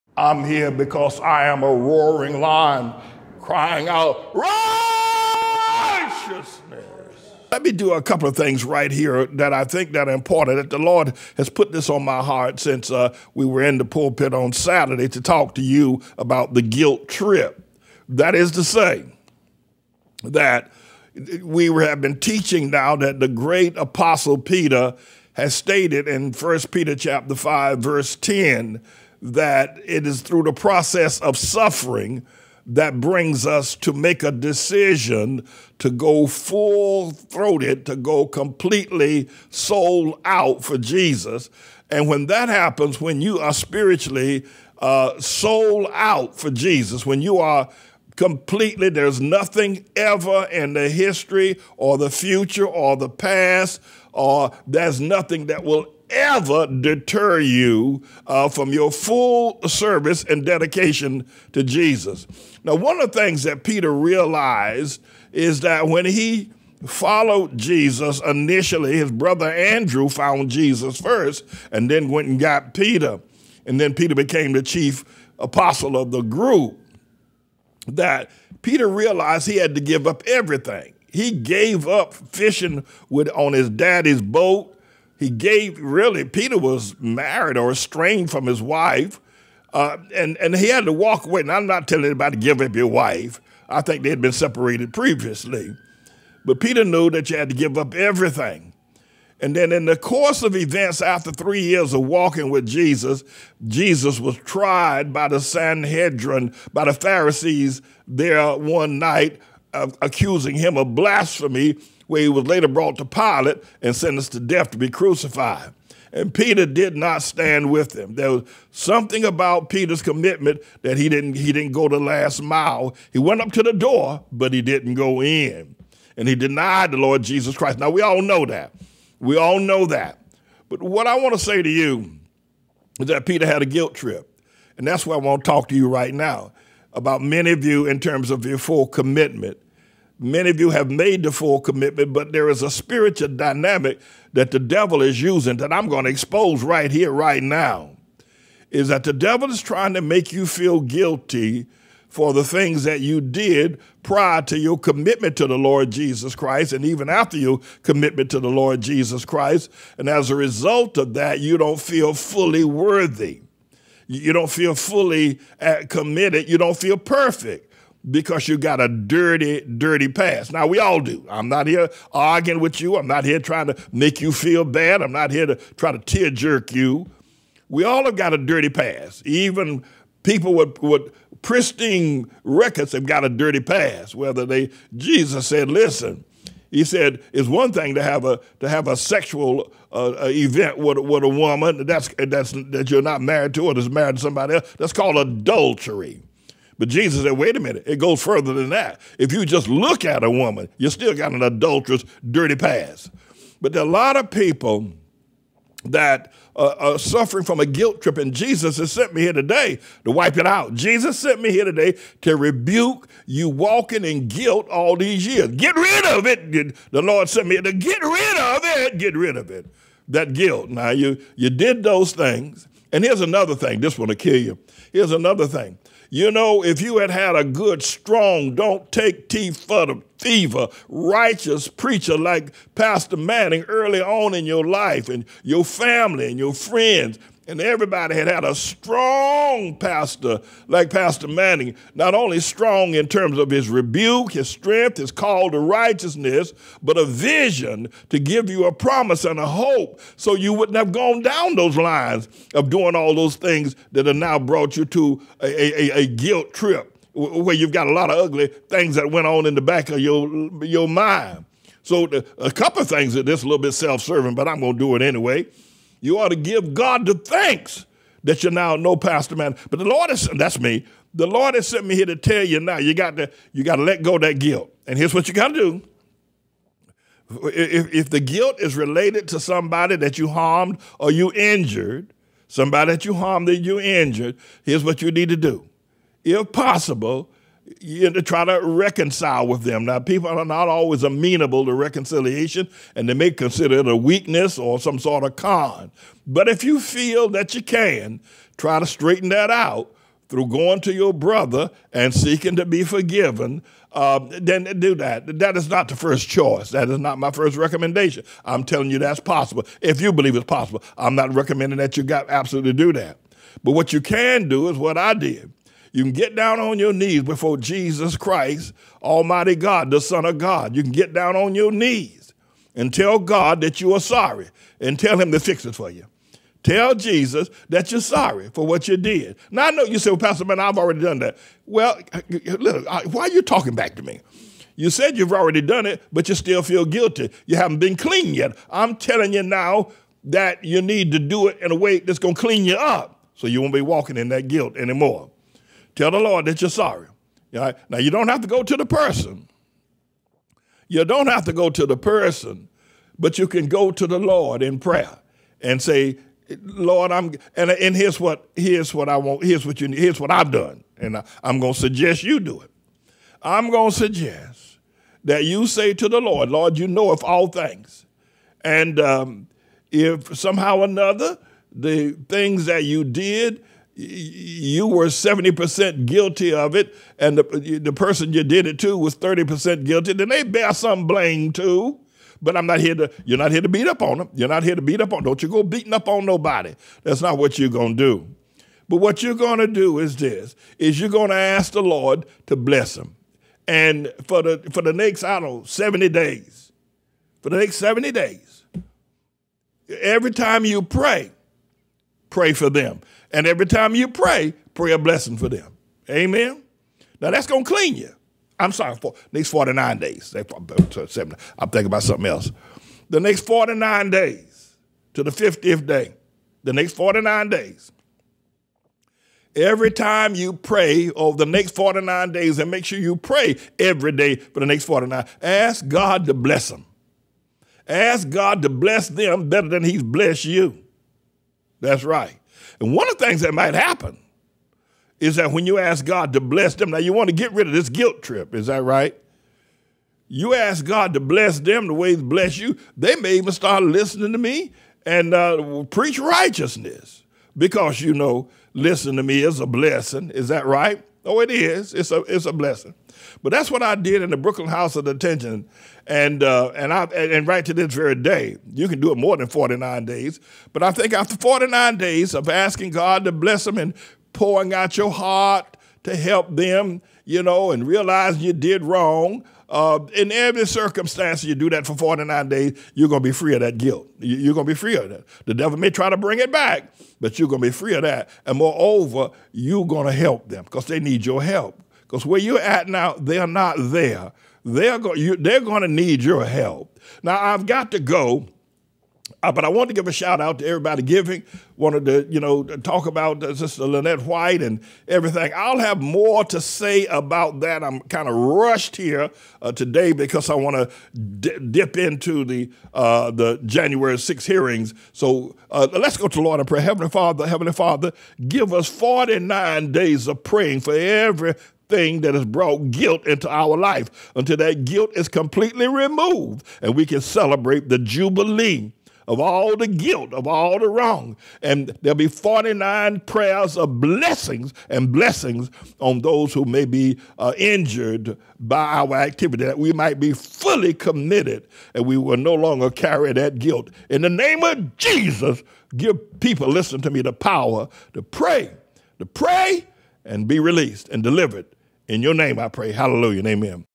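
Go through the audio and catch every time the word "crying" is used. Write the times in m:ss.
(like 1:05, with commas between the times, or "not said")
0:03.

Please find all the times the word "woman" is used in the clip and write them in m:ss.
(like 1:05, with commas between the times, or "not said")
3:11, 3:20.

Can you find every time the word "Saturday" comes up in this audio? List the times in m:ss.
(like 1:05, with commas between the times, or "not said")
0:14.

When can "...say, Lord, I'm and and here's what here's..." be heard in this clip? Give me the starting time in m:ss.
5:55.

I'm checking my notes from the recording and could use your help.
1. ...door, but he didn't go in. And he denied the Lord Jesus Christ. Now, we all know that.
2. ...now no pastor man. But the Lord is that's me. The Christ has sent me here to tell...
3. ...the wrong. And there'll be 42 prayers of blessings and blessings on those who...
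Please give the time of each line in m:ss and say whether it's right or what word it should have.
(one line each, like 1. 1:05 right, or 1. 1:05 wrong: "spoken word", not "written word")
1. 2:03 right
2. 4:28 wrong: "Lord", not "Christ"
3. 8:40 wrong: "49", not "42".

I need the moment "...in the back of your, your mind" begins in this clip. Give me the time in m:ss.
4:19.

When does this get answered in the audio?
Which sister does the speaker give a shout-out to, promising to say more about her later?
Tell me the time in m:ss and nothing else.
8:13.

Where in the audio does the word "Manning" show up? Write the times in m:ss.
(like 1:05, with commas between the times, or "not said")
3:53, 4:01.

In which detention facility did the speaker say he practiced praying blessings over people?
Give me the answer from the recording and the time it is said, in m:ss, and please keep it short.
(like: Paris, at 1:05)
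Brooklyn House of Detention, at 7:34.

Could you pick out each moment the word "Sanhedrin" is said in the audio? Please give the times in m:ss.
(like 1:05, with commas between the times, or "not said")
1:45.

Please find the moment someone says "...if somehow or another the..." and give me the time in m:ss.
6:09.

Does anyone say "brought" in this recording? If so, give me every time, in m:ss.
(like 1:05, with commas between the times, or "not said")
1:52, 4:14, 8:32.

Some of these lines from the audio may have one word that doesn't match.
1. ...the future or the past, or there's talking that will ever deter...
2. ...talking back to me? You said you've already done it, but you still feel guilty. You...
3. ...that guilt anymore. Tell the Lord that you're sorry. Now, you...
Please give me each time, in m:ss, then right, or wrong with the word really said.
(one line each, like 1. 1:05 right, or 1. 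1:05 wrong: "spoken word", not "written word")
1. 0:51 wrong: "nothing", not "talking"
2. 5:33 right
3. 5:44 right.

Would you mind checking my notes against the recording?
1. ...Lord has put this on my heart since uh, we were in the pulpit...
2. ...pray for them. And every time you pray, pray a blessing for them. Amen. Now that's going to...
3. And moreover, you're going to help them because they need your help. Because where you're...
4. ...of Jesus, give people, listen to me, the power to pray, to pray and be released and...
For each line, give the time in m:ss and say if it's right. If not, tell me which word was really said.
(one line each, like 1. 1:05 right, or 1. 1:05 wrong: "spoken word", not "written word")
1. 0:10 right
2. 6:42 right
3. 7:58 right
4. 8:54 right.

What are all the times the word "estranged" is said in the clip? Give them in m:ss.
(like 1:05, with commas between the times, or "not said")
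1:27.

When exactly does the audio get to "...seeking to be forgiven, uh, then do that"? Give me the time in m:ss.
5:02.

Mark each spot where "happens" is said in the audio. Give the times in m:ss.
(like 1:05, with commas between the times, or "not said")
0:42, 7:13.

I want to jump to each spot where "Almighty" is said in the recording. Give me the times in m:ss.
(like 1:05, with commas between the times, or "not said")
5:19.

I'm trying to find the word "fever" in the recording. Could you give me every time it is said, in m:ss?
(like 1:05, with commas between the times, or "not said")
3:50.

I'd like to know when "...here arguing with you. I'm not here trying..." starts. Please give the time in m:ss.
2:51.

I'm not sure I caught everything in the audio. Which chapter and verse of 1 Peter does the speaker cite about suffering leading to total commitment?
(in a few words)
Chapter 5 verse 10.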